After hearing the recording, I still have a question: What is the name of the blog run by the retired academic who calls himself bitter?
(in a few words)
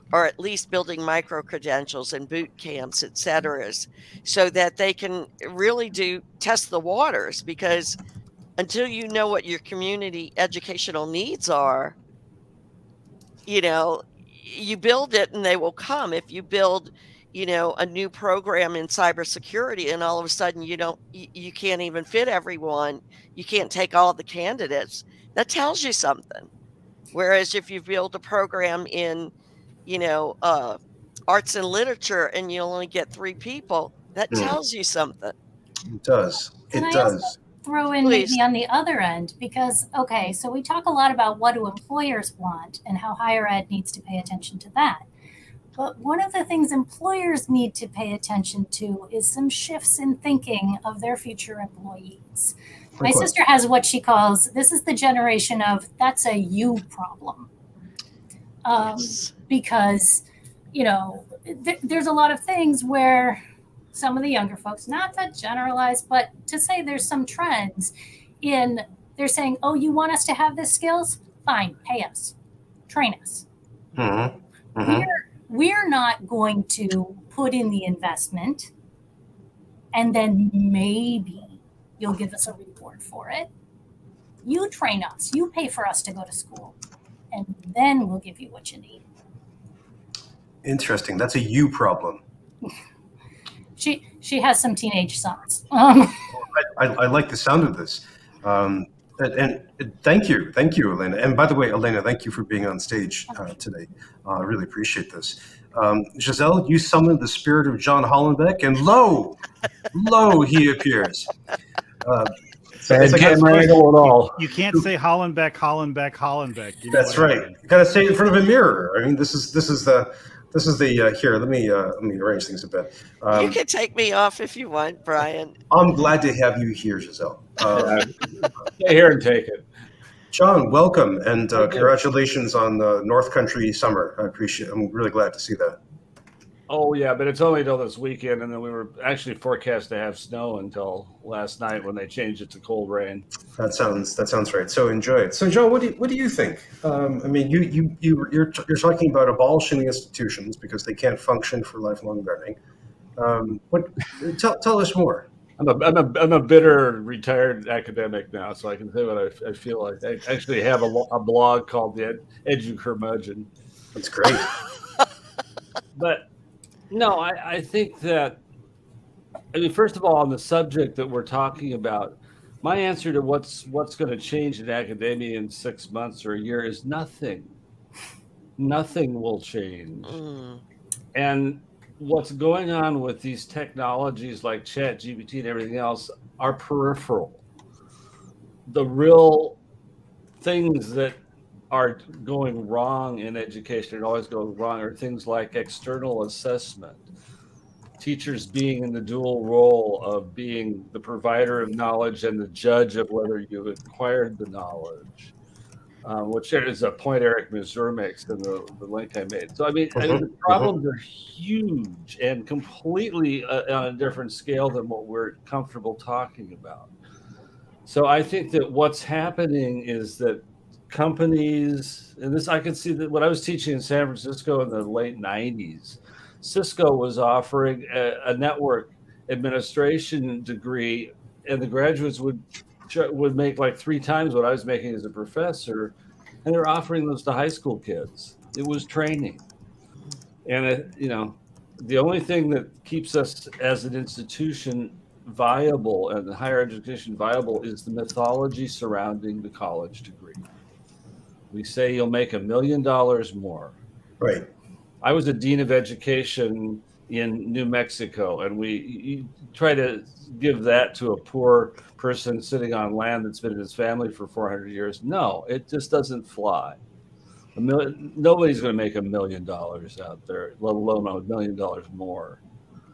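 Edu Curmudgeon.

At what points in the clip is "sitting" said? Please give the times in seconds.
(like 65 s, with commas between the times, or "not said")
262 s.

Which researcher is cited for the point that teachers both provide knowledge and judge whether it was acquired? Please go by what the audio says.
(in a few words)
Eric Mazur.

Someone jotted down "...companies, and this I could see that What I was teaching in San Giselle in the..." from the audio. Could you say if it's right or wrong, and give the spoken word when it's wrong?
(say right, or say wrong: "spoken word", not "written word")
wrong: "Francisco", not "Giselle".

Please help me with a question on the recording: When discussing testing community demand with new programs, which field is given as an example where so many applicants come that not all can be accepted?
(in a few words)
cybersecurity.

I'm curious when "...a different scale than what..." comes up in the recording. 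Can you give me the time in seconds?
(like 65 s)
213 s.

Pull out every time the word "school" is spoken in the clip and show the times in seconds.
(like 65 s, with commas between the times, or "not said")
86 s, 237 s.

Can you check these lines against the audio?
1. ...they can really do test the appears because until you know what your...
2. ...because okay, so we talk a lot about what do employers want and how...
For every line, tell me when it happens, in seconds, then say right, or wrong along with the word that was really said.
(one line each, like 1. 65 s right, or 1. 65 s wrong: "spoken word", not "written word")
1. 4 s wrong: "waters", not "appears"
2. 39 s right.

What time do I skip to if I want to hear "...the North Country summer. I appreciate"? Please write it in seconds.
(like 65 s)
132 s.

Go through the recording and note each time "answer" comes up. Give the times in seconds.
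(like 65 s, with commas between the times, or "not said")
172 s.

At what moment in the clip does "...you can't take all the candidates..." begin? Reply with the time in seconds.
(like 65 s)
23 s.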